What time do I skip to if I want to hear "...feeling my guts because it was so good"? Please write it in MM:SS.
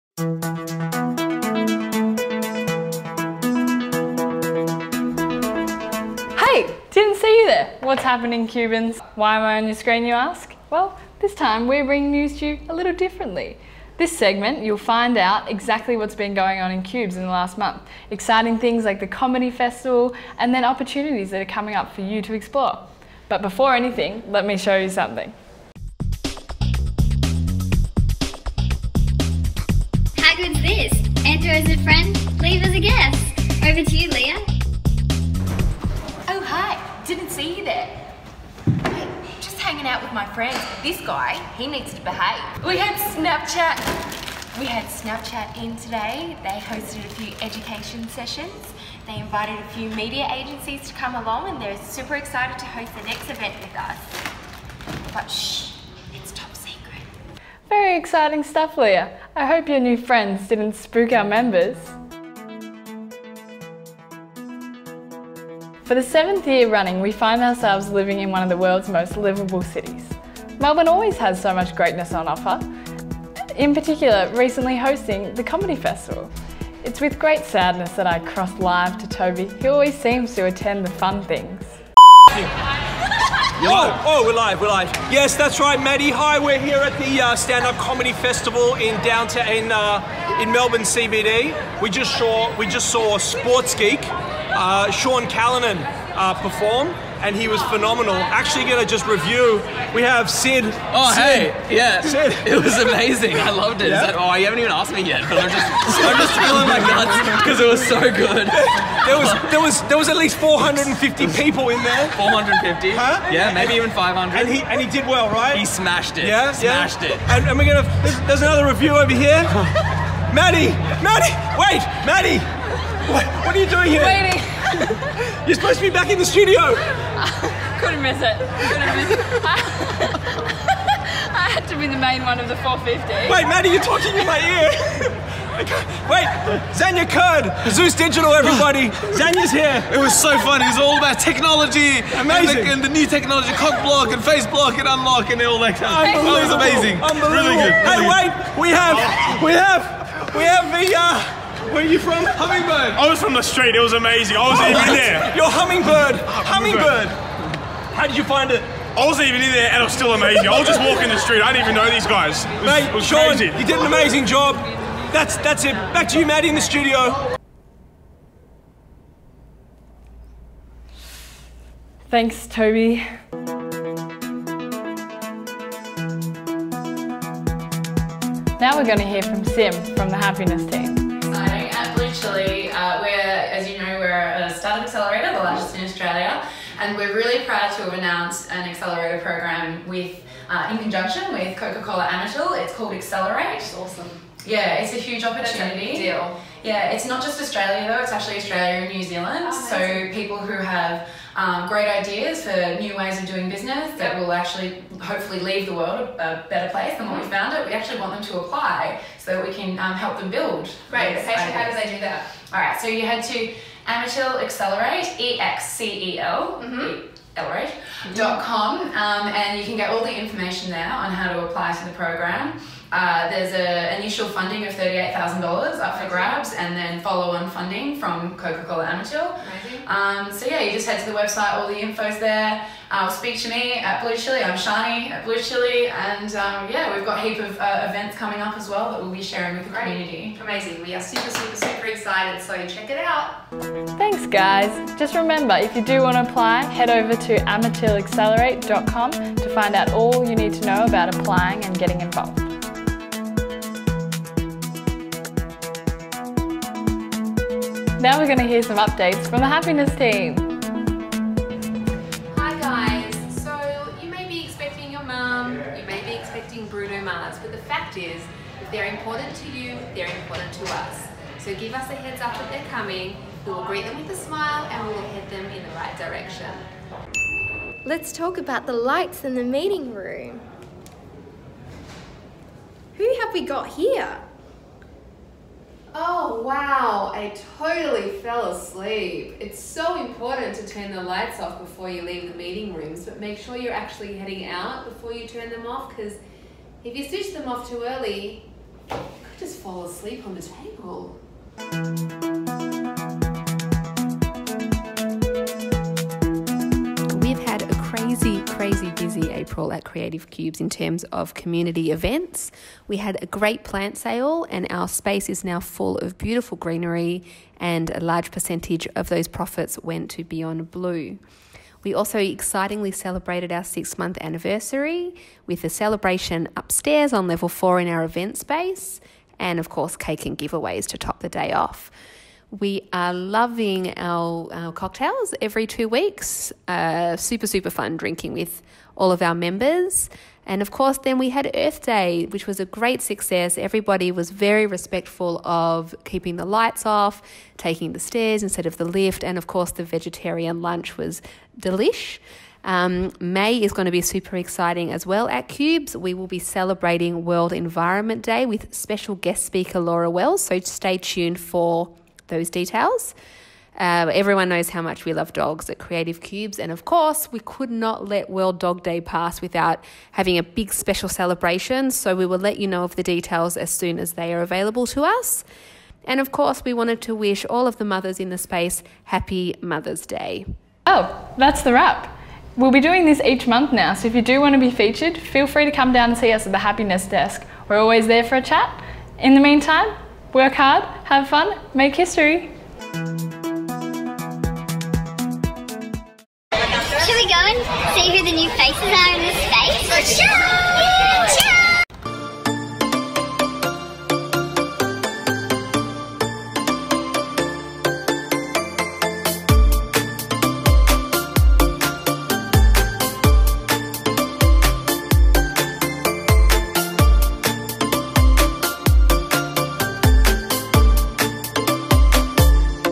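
01:46.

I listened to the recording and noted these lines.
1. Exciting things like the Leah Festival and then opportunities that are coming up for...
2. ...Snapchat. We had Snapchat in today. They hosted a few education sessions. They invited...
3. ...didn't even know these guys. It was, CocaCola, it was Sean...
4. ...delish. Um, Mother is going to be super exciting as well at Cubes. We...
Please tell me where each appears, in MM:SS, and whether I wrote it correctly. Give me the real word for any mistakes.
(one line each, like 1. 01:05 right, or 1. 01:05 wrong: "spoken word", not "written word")
1. 00:18 wrong: "Comedy", not "Leah"
2. 00:43 right
3. 02:41 wrong: "Mate", not "CocaCola"
4. 05:51 wrong: "May", not "Mother".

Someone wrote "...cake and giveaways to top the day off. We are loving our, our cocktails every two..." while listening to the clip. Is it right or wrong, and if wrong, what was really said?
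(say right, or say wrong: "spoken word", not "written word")
right.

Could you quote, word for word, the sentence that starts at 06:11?
So, we will let you know of the details as soon as they are available to us.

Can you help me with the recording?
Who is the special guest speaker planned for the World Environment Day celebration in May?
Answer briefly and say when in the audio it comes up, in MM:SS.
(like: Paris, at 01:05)
Laura Wells, at 05:59.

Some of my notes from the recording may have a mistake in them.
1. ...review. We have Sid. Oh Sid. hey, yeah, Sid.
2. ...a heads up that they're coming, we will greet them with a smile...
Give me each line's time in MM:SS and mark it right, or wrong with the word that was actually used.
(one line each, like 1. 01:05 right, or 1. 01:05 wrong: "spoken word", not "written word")
1. 01:39 right
2. 04:31 right.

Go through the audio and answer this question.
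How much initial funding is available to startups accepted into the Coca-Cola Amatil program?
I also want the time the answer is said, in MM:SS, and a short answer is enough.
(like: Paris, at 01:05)
$38,000, at 03:44.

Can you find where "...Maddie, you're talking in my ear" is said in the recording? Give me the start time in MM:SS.
02:13.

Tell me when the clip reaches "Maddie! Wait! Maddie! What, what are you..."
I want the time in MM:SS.
02:01.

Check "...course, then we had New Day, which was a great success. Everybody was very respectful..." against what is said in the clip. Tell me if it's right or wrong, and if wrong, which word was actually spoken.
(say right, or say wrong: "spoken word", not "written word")
wrong: "Earth", not "New".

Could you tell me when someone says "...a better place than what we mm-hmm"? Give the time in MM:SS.
03:26.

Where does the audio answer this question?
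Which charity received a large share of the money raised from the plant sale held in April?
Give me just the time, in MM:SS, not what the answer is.
05:20.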